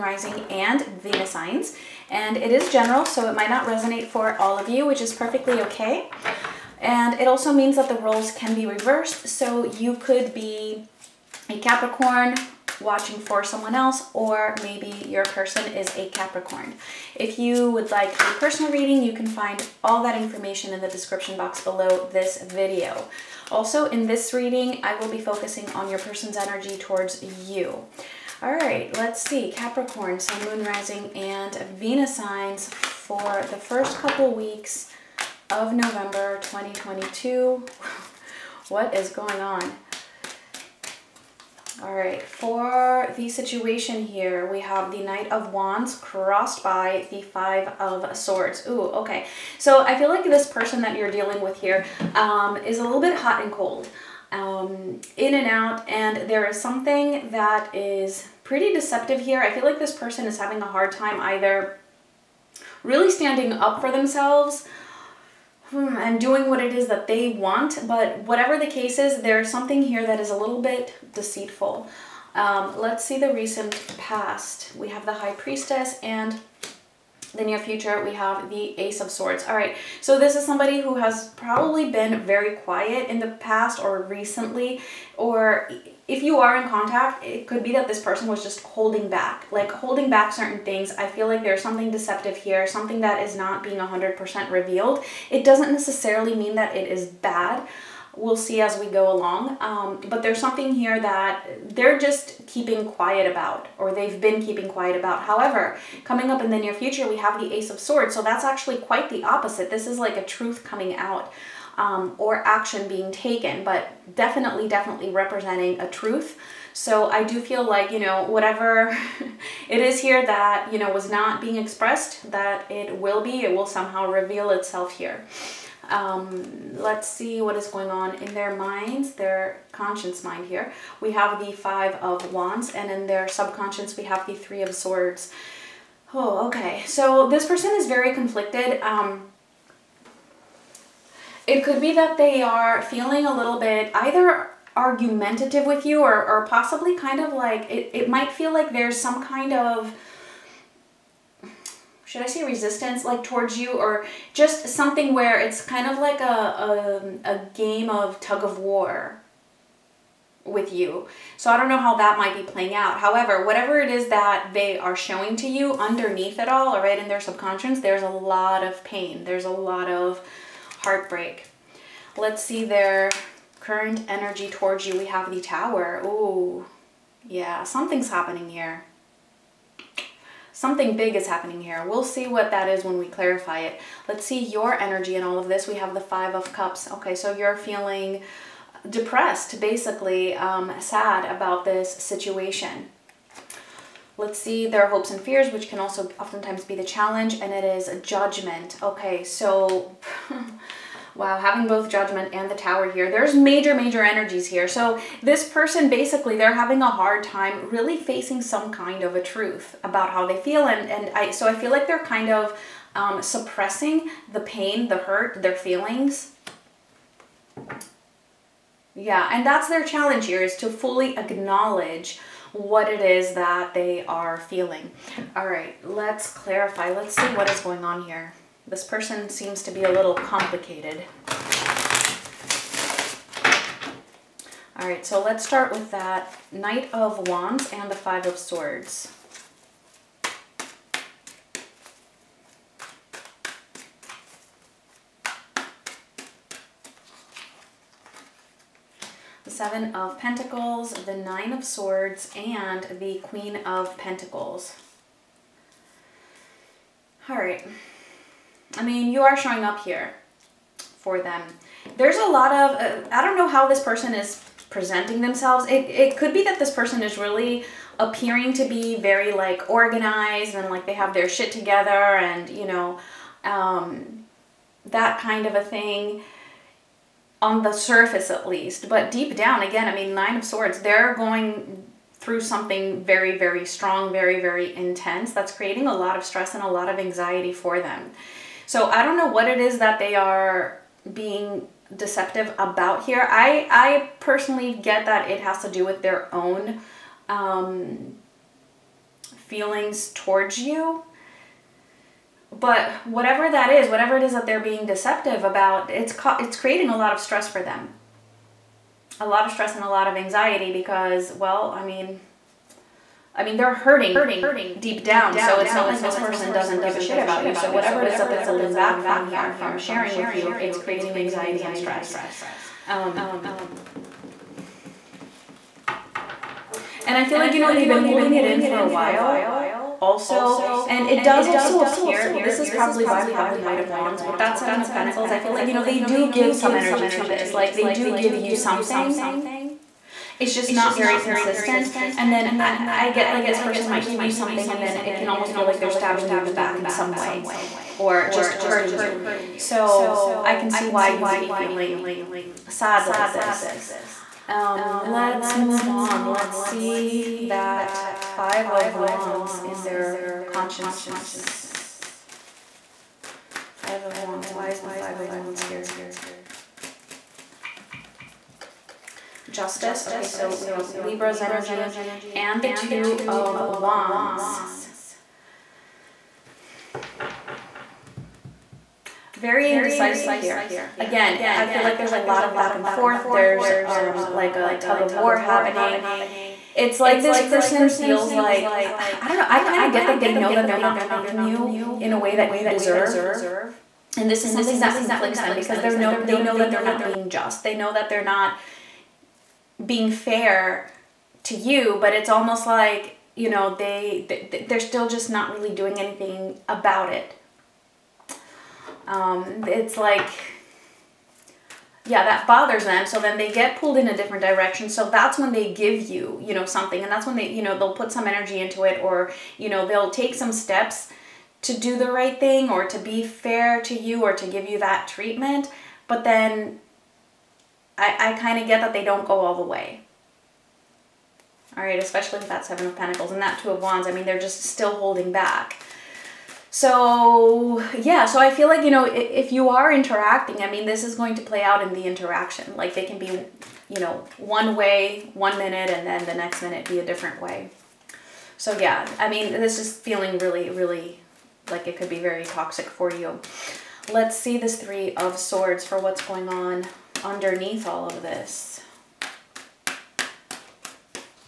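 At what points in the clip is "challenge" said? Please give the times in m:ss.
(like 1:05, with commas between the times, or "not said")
3:16, 3:39.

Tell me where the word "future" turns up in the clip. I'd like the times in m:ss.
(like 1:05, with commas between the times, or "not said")
1:17, 1:46.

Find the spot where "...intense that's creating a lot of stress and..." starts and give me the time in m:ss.
4:44.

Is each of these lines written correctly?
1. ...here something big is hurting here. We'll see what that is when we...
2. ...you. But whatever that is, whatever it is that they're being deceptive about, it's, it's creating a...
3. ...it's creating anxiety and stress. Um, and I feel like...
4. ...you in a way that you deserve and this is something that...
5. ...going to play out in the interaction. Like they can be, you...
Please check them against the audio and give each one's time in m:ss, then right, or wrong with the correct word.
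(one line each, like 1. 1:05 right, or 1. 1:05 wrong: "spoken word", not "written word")
1. 2:58 wrong: "happening", not "hurting"
2. 5:00 right
3. 5:20 right
4. 6:31 right
5. 7:21 right.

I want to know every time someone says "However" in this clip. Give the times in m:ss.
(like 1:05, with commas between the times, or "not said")
1:45, 2:42.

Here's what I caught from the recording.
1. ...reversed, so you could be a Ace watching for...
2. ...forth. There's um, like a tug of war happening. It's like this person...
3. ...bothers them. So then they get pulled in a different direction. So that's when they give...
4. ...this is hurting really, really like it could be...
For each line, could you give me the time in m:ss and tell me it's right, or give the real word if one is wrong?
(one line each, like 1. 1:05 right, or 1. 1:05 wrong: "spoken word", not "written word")
1. 0:08 wrong: "Capricorn", not "Ace"
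2. 6:22 right
3. 6:52 right
4. 7:29 wrong: "feeling", not "hurting".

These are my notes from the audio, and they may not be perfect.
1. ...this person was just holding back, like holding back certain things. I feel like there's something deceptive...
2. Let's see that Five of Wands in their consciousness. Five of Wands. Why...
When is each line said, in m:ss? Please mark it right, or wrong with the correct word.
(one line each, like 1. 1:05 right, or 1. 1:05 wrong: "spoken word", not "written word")
1. 1:27 right
2. 5:56 right.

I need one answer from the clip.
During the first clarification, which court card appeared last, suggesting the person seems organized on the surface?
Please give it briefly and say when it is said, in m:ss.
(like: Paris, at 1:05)
Queen of Pentacles, at 4:13.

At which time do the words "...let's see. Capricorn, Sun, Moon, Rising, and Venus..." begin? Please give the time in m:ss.
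0:28.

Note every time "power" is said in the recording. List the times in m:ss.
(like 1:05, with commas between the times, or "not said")
not said.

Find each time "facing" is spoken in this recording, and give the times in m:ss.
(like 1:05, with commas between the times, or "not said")
3:27.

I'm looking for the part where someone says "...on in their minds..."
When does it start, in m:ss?
2:07.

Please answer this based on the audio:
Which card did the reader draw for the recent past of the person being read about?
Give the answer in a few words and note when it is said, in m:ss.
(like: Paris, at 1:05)
High Priestess, at 1:15.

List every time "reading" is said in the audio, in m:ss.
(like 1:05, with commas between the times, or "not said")
0:18, 0:24.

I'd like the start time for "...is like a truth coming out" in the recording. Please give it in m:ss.
1:49.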